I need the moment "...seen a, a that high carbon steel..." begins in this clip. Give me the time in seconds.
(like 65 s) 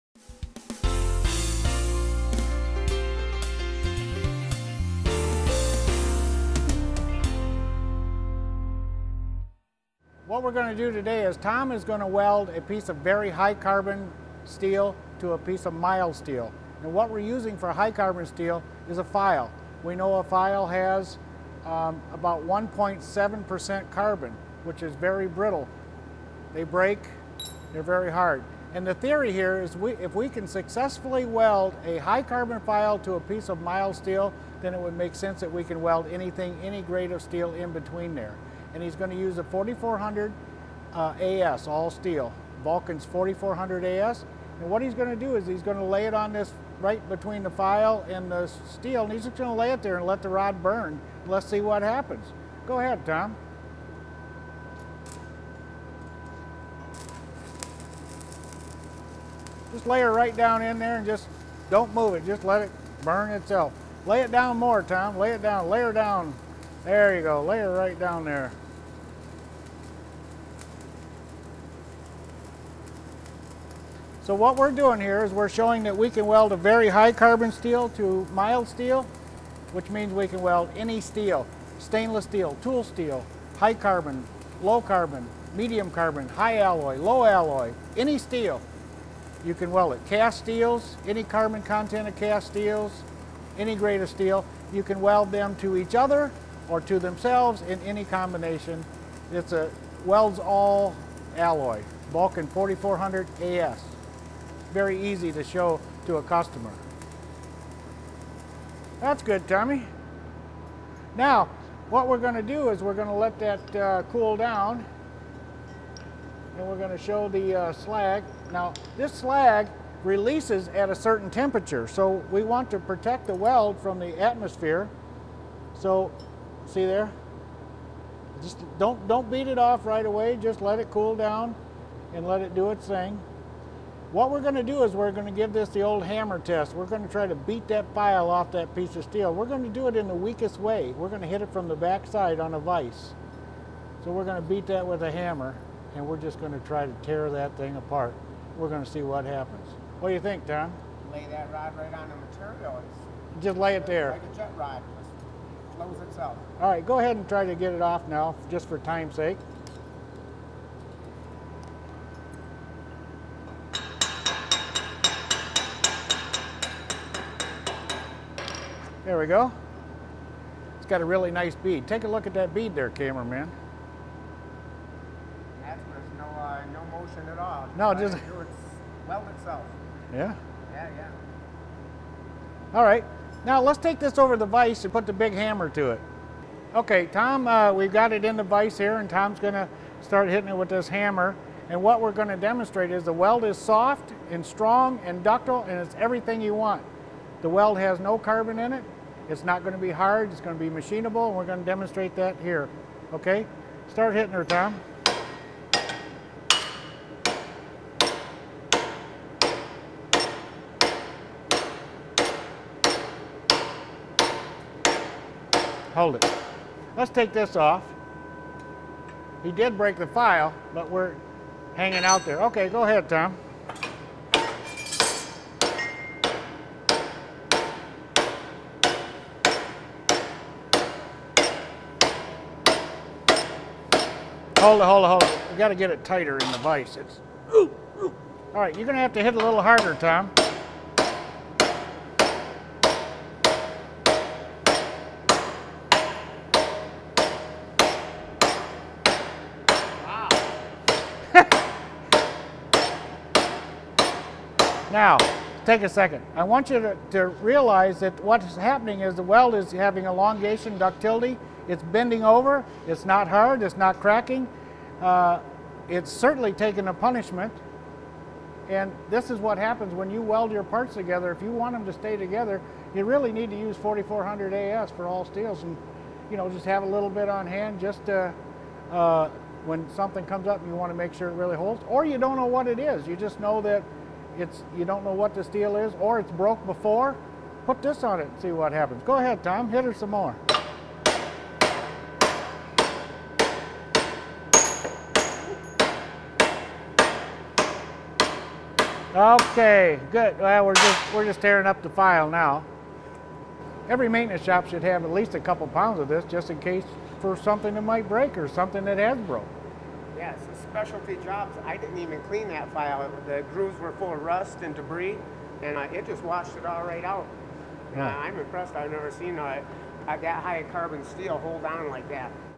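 319 s.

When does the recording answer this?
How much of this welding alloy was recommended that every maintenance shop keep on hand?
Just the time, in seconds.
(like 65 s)
305 s.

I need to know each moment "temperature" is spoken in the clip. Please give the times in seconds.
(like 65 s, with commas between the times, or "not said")
121 s.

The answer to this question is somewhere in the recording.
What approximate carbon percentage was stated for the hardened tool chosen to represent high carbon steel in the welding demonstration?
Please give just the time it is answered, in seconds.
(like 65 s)
22 s.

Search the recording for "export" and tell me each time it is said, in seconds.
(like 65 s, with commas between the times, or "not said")
not said.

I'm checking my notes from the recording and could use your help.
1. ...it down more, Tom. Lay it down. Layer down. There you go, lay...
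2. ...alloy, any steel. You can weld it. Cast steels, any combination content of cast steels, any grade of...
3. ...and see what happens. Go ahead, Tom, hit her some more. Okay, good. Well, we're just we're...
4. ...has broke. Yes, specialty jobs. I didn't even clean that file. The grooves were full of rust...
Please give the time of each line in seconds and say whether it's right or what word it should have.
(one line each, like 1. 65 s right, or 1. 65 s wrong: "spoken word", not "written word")
1. 64 s right
2. 87 s wrong: "carbon", not "combination"
3. 288 s right
4. 308 s right.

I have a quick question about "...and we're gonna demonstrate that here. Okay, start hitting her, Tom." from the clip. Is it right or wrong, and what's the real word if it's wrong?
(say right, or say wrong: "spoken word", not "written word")
right.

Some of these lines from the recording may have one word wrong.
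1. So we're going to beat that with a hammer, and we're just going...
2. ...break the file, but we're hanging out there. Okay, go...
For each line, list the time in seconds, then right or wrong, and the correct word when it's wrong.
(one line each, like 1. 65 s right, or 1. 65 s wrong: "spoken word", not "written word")
1. 144 s right
2. 219 s right.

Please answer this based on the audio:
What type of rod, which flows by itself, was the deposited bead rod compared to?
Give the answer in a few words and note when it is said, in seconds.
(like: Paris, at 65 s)
Jet rod, at 154 s.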